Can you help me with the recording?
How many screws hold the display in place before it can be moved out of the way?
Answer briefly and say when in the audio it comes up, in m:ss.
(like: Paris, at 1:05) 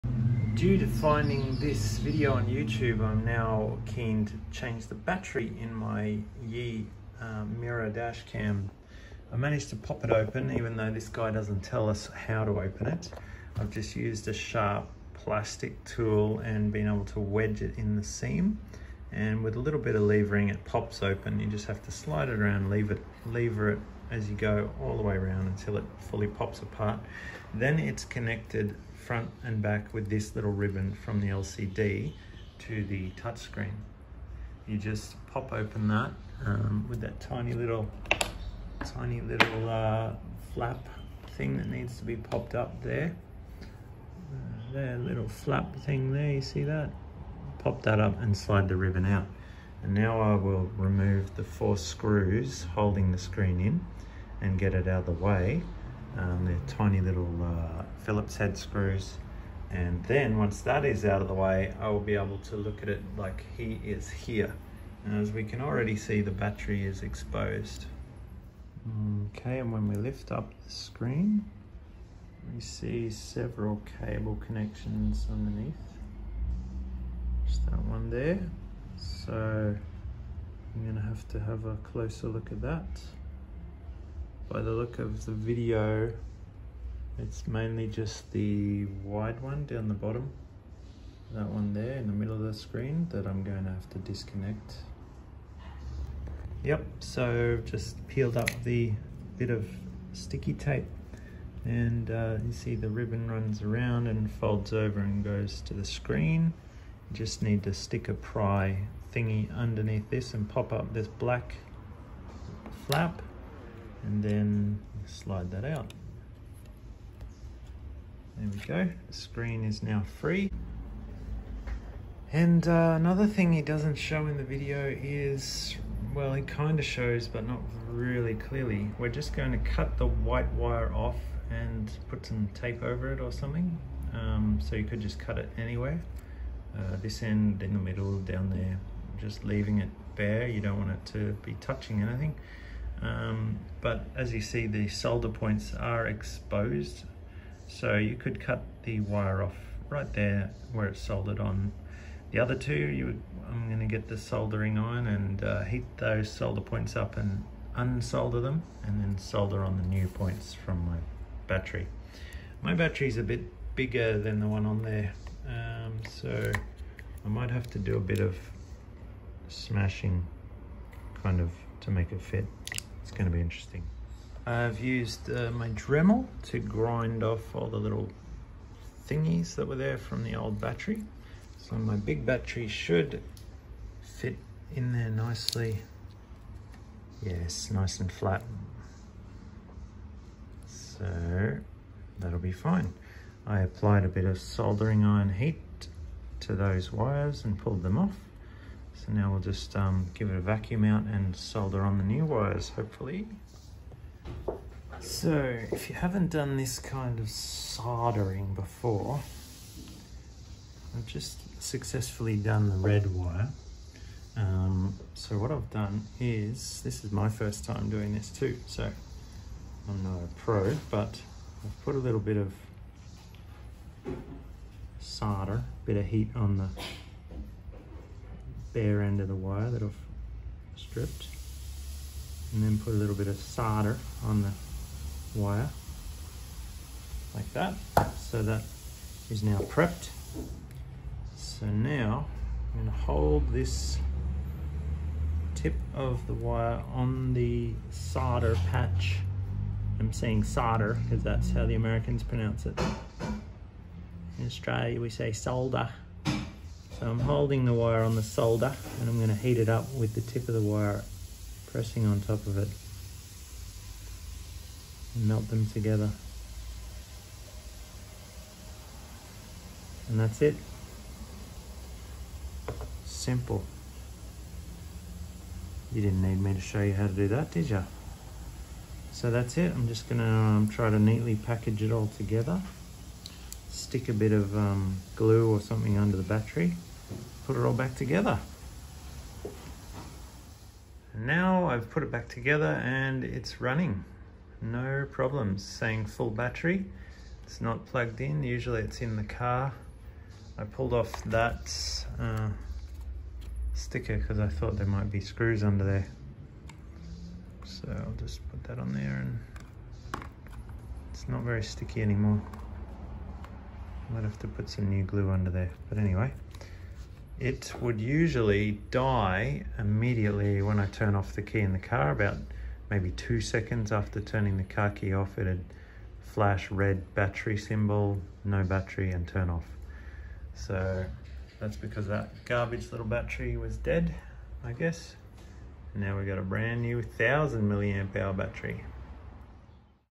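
4, at 0:51.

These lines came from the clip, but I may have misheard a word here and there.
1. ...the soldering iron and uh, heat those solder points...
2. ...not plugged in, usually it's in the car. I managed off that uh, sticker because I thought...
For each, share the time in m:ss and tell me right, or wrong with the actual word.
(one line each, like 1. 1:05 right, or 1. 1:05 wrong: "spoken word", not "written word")
1. 2:34 right
2. 4:57 wrong: "pulled", not "managed".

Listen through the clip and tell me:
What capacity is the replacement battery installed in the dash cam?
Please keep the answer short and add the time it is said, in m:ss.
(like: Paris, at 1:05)
1000 mAh, at 5:37.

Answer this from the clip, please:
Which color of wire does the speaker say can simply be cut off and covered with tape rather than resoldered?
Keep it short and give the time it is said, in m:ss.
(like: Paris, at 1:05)
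White, at 2:10.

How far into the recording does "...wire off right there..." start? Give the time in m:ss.
2:29.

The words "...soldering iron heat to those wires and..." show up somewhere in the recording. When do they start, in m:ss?
3:14.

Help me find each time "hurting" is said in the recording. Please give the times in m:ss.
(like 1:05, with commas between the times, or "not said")
not said.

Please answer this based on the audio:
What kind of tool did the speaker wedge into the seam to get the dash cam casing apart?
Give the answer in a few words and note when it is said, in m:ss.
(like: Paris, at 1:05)
Sharp plastic tool, at 0:14.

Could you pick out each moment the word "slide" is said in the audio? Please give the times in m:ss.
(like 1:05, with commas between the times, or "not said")
0:21, 0:48, 1:55.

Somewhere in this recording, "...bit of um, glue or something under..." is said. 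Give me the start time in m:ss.
4:44.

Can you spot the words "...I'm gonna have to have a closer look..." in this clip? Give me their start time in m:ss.
1:20.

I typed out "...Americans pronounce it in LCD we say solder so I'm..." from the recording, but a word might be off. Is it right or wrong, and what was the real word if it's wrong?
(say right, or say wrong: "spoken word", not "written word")
wrong: "Australia", not "LCD".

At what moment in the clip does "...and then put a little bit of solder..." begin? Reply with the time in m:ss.
3:52.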